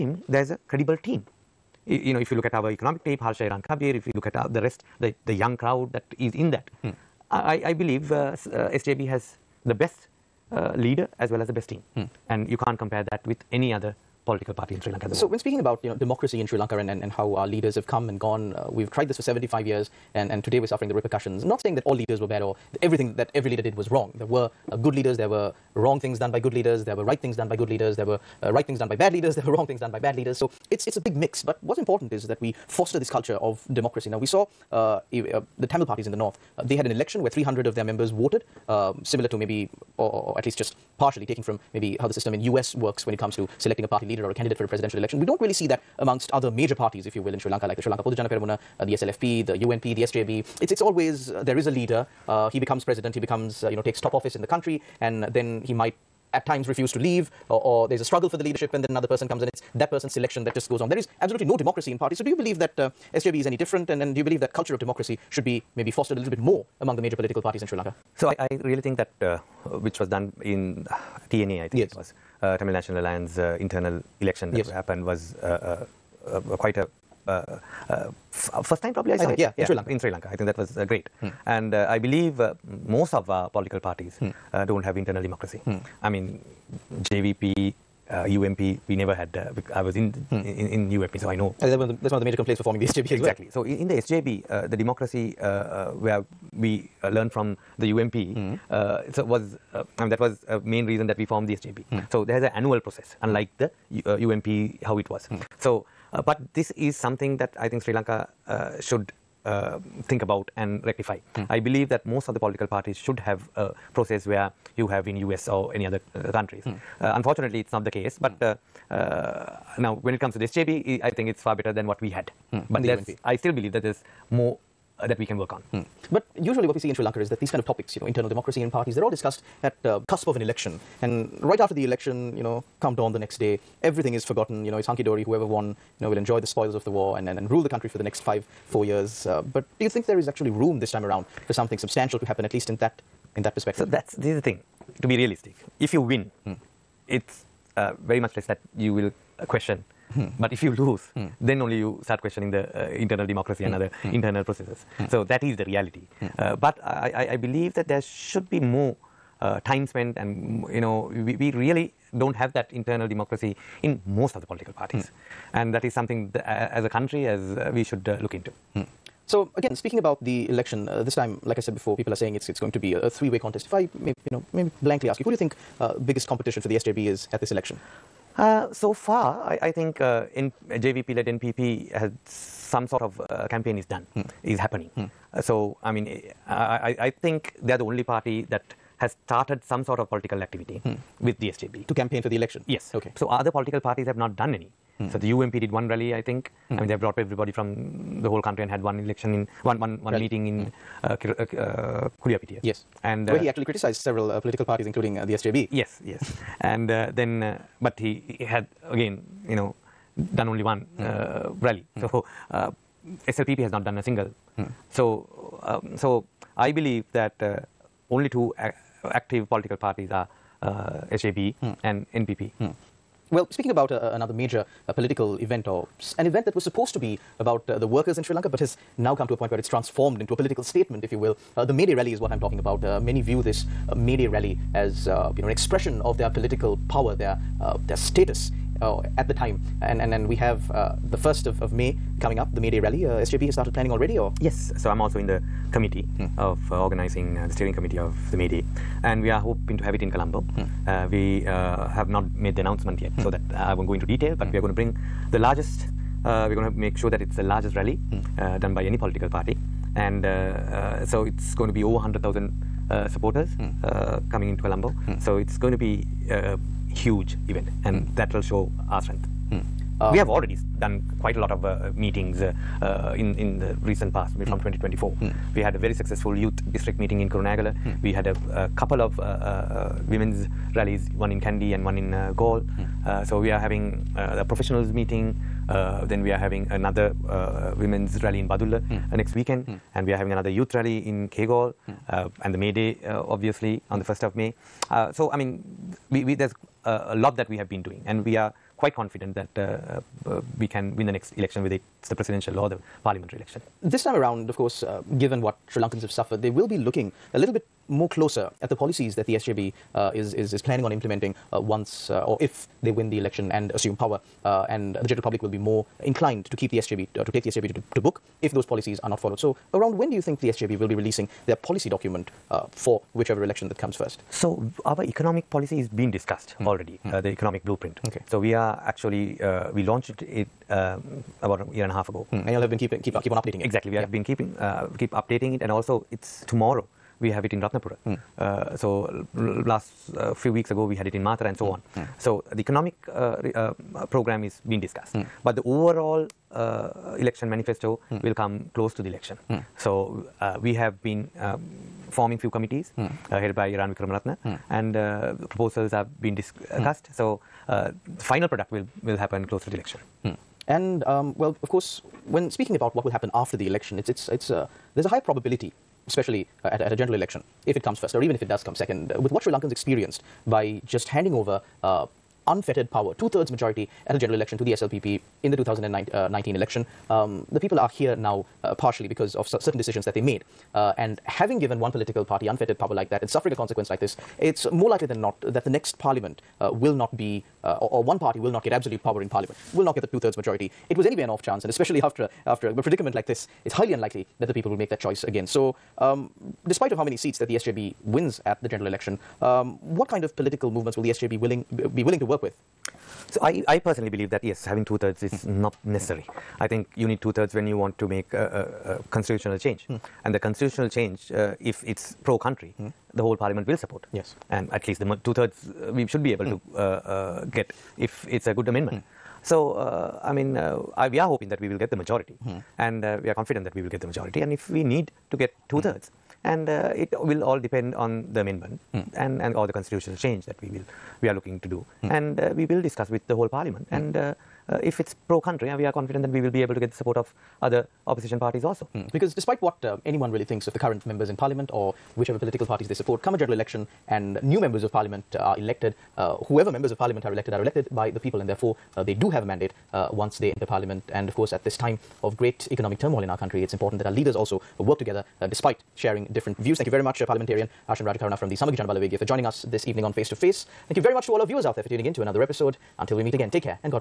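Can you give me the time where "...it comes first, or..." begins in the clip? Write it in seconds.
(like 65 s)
367 s.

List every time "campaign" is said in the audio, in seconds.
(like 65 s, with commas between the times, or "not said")
183 s, 191 s.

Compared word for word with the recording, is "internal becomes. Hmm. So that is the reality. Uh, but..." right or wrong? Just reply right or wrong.
wrong.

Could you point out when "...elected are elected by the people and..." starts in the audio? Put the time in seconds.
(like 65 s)
447 s.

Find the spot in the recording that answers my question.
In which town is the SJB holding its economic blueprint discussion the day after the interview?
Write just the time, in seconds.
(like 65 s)
337 s.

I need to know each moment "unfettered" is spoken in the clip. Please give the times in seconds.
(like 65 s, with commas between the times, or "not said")
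372 s, 382 s.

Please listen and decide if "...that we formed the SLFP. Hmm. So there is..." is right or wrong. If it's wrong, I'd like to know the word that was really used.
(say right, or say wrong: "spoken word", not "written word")
wrong: "SJB", not "SLFP".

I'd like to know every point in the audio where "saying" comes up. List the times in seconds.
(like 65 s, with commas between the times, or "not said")
21 s, 172 s.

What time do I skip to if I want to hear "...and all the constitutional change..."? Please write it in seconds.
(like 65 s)
429 s.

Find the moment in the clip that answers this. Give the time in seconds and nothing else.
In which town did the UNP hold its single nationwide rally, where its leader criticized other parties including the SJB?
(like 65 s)
202 s.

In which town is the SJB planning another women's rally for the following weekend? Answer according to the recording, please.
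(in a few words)
Badulla.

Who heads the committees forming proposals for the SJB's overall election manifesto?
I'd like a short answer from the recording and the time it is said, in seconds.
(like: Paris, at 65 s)
Eran Wickramaratne, at 353 s.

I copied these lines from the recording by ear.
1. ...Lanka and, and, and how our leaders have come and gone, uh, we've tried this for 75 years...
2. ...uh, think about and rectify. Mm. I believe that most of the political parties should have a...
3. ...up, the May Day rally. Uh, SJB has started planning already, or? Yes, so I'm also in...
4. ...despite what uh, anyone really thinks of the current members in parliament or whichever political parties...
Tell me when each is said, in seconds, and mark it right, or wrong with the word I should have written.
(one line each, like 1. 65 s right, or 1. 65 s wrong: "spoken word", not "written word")
1. 16 s right
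2. 109 s right
3. 242 s right
4. 439 s right.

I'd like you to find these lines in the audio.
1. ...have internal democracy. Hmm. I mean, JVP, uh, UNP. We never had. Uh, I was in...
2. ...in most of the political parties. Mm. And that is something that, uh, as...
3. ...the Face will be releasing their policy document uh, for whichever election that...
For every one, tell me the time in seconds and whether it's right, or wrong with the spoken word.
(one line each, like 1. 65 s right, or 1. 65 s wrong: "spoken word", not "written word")
1. 84 s right
2. 163 s right
3. 320 s wrong: "SJB", not "Face".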